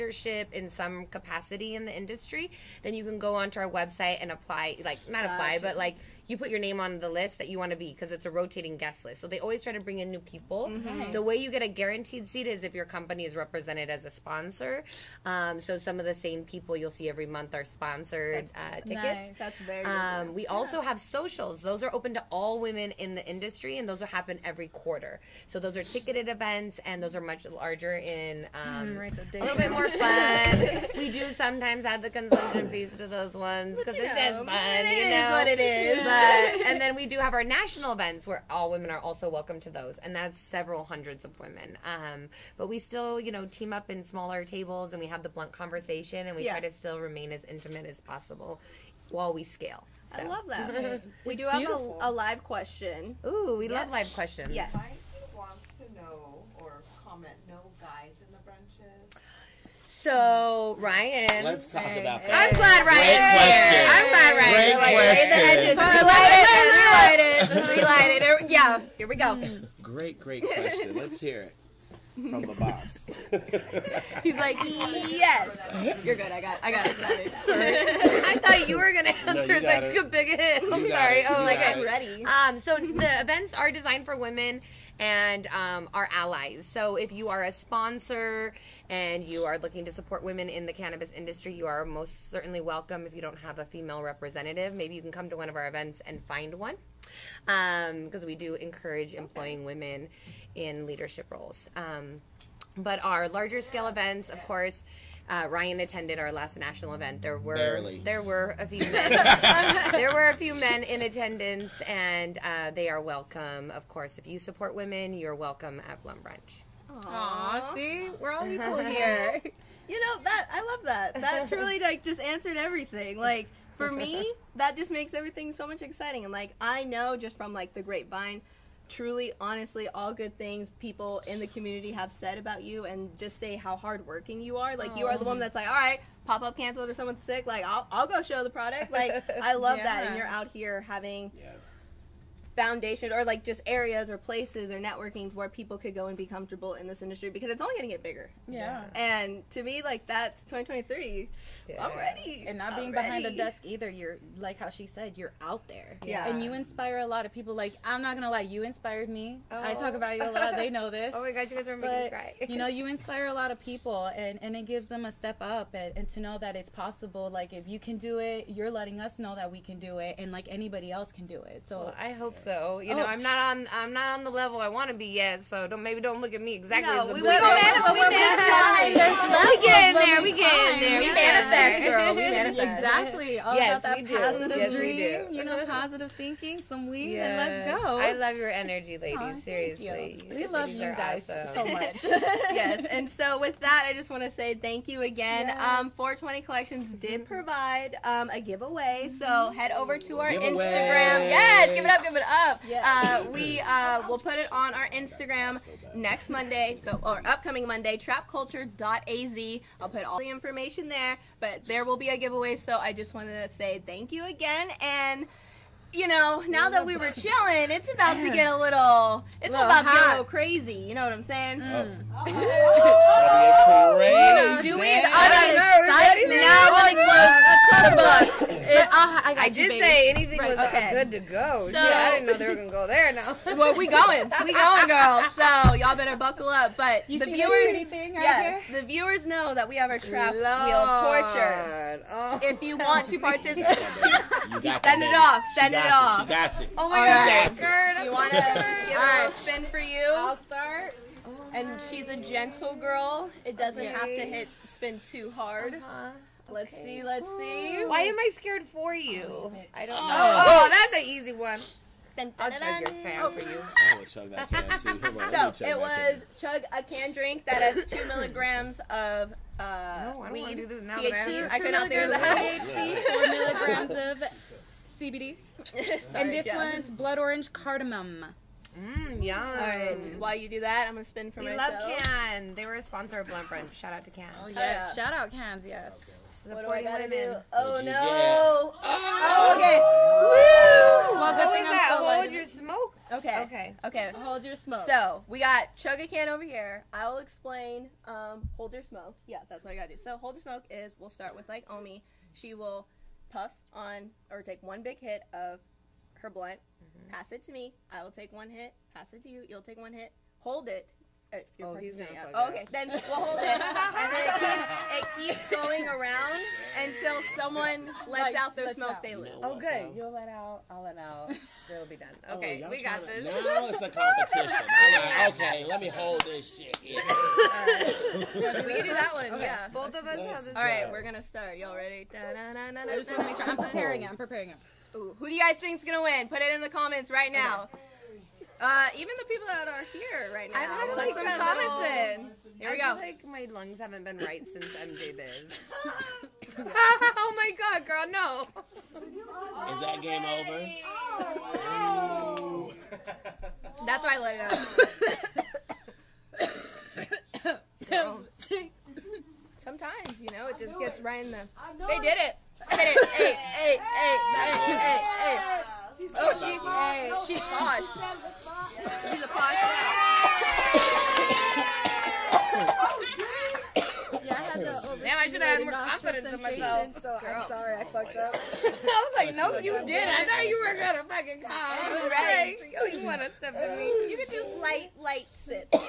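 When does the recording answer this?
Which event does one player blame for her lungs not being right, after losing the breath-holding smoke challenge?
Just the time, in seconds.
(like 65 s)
344 s.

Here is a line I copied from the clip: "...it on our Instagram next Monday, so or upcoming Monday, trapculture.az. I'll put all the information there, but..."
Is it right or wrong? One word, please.
right.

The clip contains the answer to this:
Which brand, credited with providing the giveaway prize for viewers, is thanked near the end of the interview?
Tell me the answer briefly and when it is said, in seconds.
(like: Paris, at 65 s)
420 Collections, at 195 s.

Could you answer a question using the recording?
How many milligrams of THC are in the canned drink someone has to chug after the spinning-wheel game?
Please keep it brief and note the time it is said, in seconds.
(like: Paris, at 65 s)
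2, at 267 s.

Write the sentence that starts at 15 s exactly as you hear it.
Um, so some of the same people you'll see every month are sponsored uh, tickets.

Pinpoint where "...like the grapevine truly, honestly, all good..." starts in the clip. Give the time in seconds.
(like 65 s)
127 s.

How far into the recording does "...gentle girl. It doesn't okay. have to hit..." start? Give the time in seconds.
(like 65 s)
252 s.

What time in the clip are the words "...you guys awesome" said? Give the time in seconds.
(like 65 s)
190 s.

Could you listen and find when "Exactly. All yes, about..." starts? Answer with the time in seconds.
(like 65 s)
182 s.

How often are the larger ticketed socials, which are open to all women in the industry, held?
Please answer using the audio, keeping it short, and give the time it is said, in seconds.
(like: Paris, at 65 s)
Every quarter, at 24 s.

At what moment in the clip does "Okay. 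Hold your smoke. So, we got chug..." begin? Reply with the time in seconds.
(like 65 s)
293 s.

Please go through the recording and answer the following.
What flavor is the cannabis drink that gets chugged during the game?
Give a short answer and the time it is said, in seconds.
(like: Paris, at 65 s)
Blood orange cardamom, at 276 s.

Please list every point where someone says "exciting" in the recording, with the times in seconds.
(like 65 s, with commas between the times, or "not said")
125 s.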